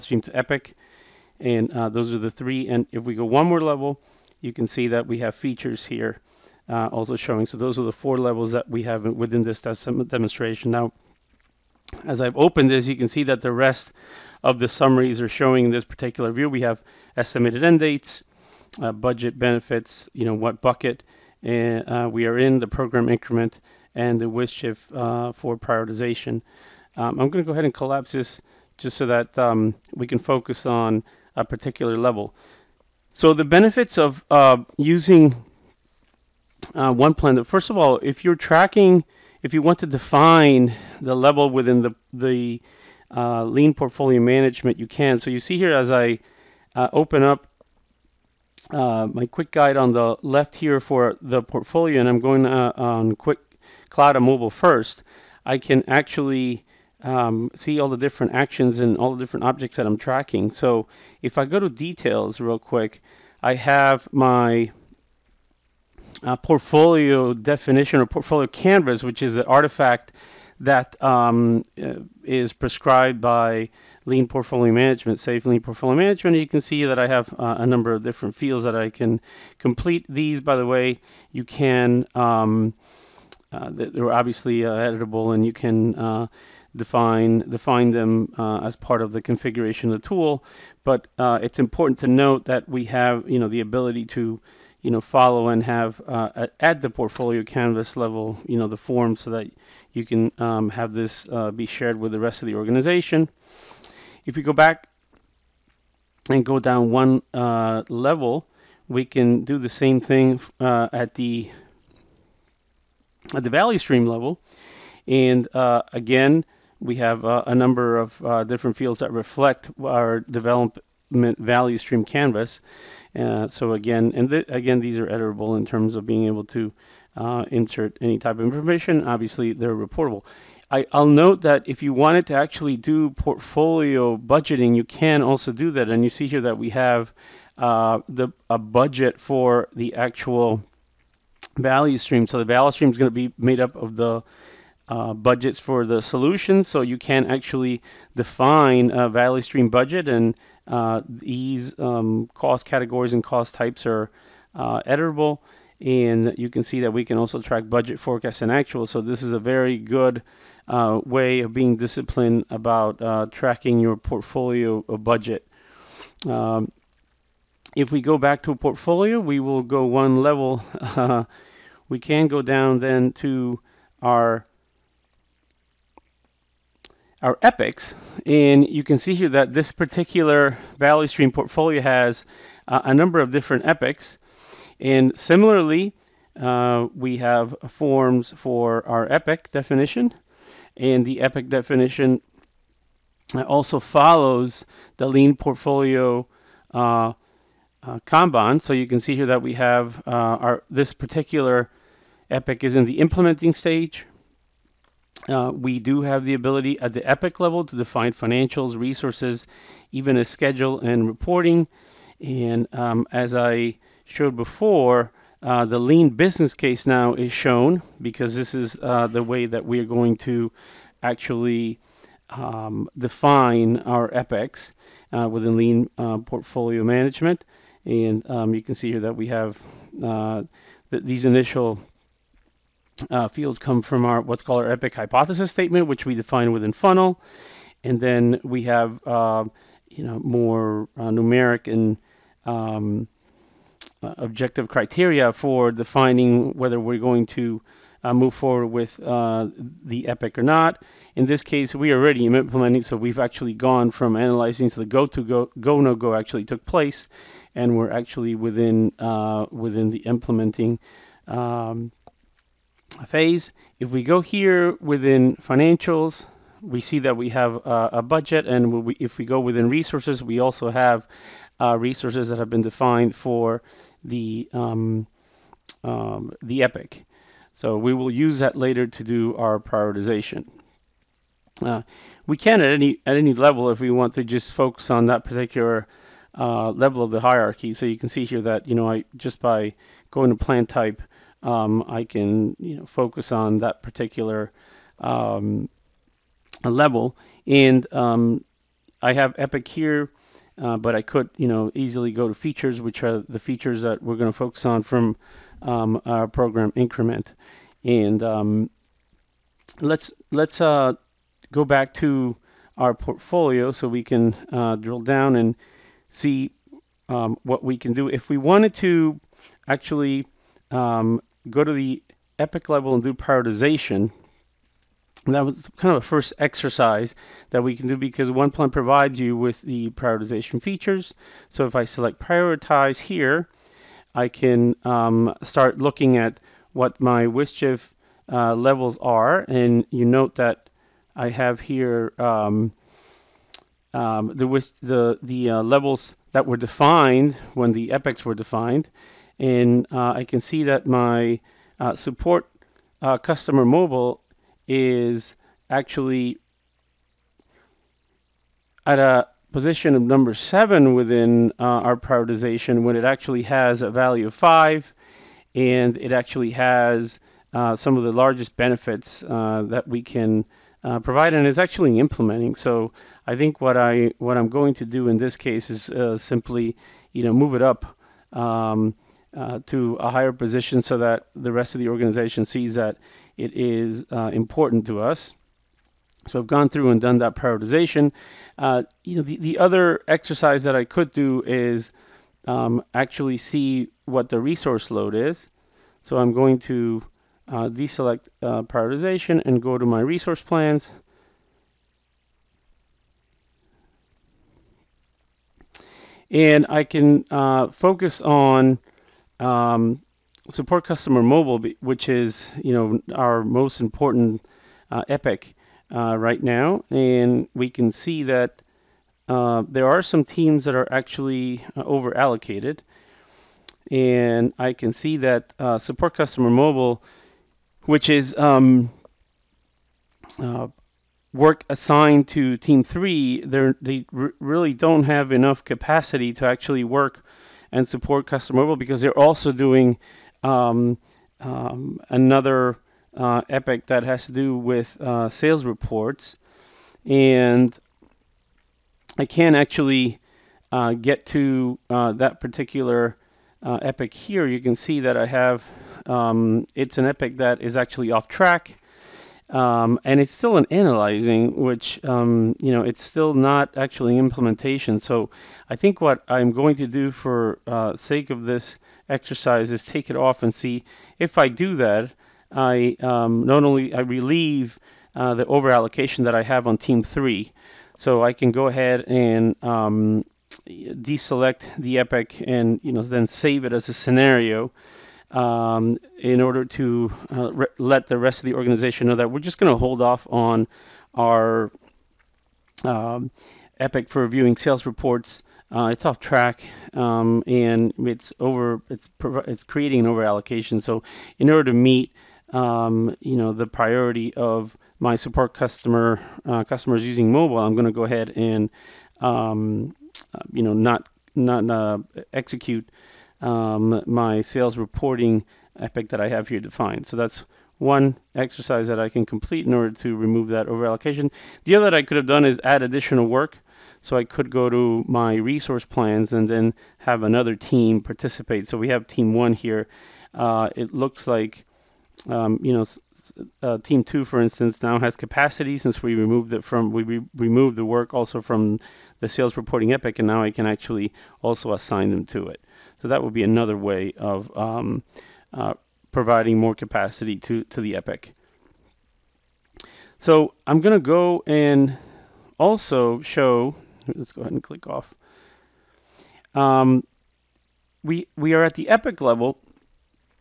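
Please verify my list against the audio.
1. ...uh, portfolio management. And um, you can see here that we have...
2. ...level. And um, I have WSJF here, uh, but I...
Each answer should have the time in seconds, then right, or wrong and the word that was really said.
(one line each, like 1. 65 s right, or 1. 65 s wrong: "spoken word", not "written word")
1. 225 s right
2. 296 s wrong: "Epic", not "WSJF".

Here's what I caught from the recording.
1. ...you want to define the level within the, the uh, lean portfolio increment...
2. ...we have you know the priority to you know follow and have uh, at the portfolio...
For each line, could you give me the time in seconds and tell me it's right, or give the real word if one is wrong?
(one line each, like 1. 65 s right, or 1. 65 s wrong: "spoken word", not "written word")
1. 39 s wrong: "management", not "increment"
2. 92 s wrong: "ability", not "priority".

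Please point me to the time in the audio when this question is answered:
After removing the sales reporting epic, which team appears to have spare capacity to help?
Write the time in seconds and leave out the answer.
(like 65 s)
533 s.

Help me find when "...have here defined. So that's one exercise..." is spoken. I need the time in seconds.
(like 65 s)
516 s.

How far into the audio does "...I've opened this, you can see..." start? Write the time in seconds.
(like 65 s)
12 s.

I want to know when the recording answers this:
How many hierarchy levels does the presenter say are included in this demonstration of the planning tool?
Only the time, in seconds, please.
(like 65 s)
7 s.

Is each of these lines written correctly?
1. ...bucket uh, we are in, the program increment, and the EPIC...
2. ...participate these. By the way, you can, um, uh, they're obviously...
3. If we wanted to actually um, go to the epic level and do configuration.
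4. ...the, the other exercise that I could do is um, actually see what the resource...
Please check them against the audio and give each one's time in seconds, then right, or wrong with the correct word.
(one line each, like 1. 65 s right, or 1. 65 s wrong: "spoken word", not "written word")
1. 20 s wrong: "WSJF", not "EPIC"
2. 79 s wrong: "complete", not "participate"
3. 318 s wrong: "prioritization", not "configuration"
4. 389 s right.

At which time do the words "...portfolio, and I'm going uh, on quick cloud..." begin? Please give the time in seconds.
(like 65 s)
51 s.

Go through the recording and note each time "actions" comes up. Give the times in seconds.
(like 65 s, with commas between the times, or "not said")
58 s.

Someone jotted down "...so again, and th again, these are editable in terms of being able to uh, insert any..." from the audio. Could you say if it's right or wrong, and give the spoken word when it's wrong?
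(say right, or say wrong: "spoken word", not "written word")
right.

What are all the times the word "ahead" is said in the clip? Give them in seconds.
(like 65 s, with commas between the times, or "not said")
27 s, 478 s, 508 s, 554 s.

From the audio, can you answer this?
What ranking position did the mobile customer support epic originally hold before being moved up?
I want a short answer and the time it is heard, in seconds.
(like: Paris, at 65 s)
7, at 360 s.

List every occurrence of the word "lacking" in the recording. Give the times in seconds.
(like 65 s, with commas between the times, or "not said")
not said.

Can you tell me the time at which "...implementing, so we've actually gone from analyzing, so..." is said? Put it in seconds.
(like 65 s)
252 s.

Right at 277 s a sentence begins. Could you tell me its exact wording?
So we will use that later to do our prioritization.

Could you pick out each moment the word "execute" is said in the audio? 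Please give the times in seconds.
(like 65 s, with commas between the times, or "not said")
512 s.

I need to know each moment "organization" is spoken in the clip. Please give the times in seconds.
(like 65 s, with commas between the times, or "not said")
102 s, 381 s, 488 s.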